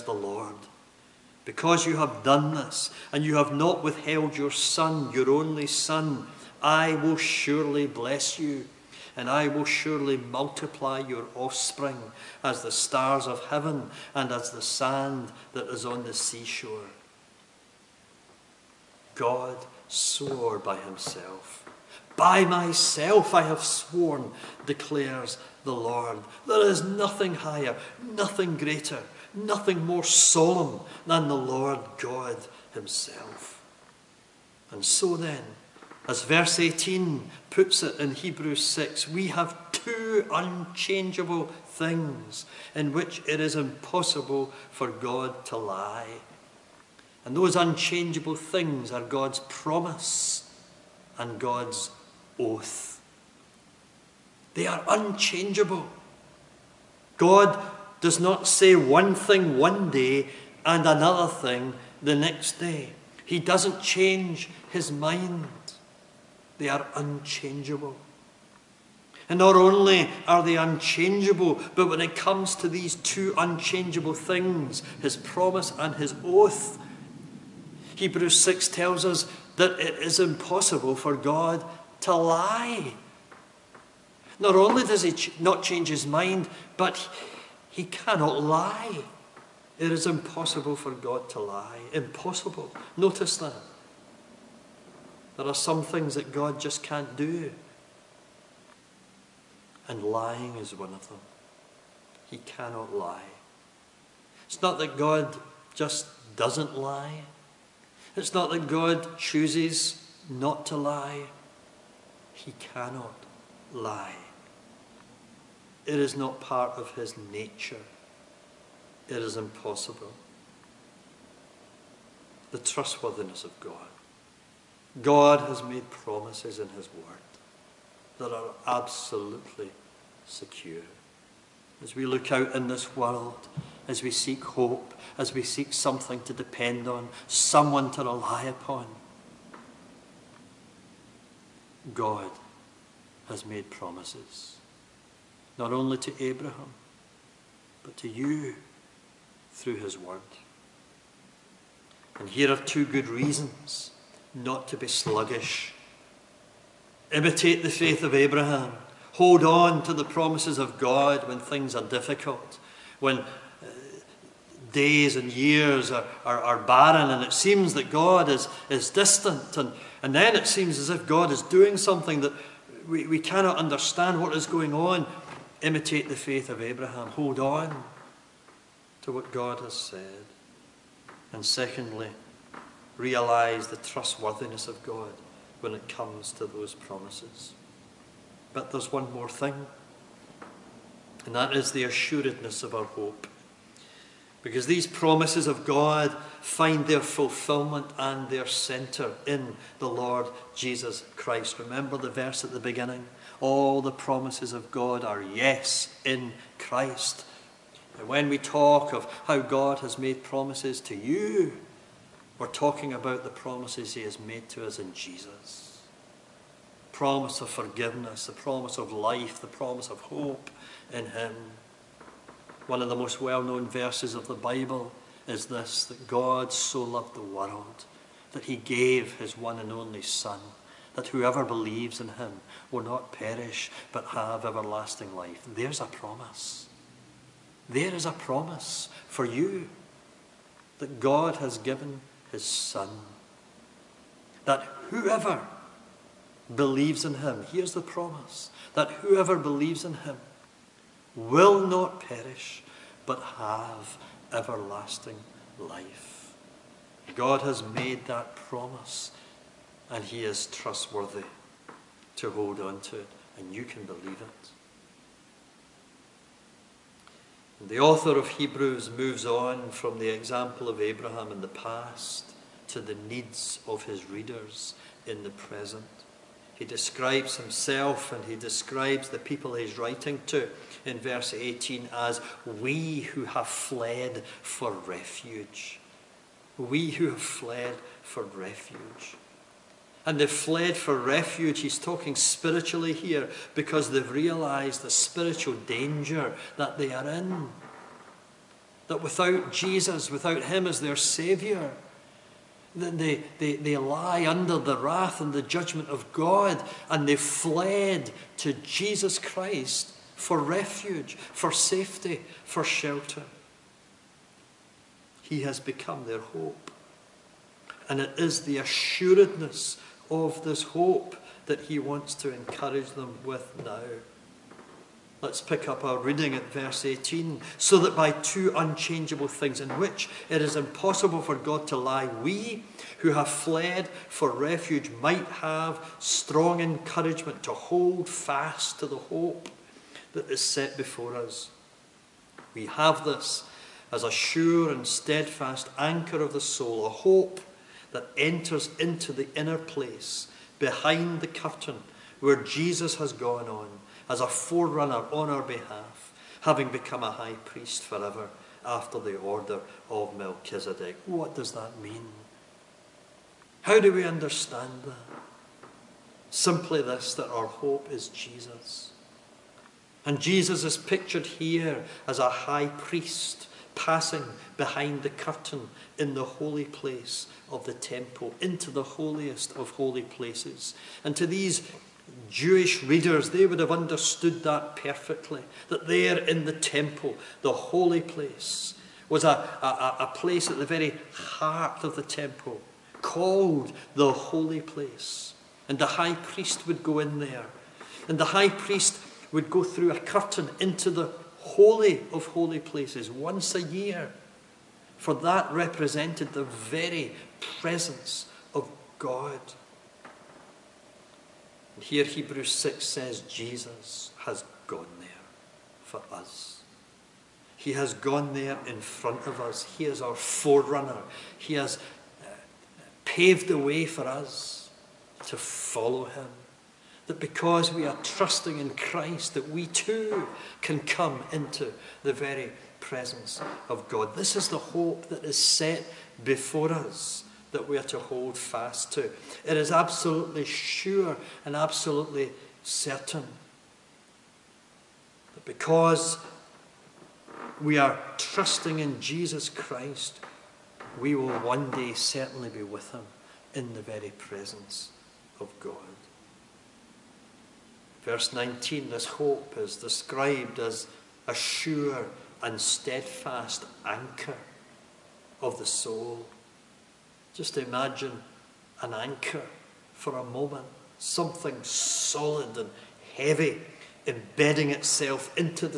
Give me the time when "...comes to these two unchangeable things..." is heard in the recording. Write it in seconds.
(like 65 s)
72 s.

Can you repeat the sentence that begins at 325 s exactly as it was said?
Let's pick up our reading at verse 18.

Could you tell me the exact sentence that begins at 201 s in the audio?
Remember the verse at the beginning?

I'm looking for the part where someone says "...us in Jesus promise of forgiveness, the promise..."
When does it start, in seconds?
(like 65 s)
214 s.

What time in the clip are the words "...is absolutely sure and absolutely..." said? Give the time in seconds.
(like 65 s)
439 s.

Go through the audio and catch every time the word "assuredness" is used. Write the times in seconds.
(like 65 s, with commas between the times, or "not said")
191 s, 318 s.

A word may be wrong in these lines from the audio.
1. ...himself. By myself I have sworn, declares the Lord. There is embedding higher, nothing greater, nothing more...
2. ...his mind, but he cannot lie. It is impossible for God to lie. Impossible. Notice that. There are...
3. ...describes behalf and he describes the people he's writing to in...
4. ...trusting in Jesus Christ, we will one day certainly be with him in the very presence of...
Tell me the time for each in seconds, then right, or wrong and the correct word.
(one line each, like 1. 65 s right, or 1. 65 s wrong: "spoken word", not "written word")
1. 20 s wrong: "nothing", not "embedding"
2. 85 s right
3. 276 s wrong: "himself", not "behalf"
4. 448 s right.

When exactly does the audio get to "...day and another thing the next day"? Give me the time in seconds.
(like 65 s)
59 s.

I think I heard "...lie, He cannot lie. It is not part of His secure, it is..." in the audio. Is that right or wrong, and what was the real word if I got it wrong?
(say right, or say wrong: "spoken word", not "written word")
wrong: "nature", not "secure".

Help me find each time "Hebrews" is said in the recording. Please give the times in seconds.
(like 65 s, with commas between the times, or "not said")
38 s, 78 s, 268 s, 412 s.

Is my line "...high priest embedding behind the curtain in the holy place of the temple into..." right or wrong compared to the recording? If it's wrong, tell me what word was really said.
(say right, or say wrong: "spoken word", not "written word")
wrong: "passing", not "embedding".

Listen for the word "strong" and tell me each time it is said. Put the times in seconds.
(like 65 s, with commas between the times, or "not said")
335 s.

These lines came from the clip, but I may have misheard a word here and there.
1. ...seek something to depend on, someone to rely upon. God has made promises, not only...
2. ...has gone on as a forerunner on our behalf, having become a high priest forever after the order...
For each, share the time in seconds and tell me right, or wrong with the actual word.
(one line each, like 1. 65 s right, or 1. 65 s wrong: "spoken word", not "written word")
1. 135 s right
2. 352 s right.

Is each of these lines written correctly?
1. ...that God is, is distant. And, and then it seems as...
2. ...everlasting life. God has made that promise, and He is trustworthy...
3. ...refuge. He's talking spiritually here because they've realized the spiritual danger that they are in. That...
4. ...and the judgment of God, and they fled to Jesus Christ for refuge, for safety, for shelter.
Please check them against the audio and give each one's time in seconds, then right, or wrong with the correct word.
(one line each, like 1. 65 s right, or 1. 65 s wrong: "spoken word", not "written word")
1. 167 s right
2. 254 s right
3. 290 s right
4. 305 s right.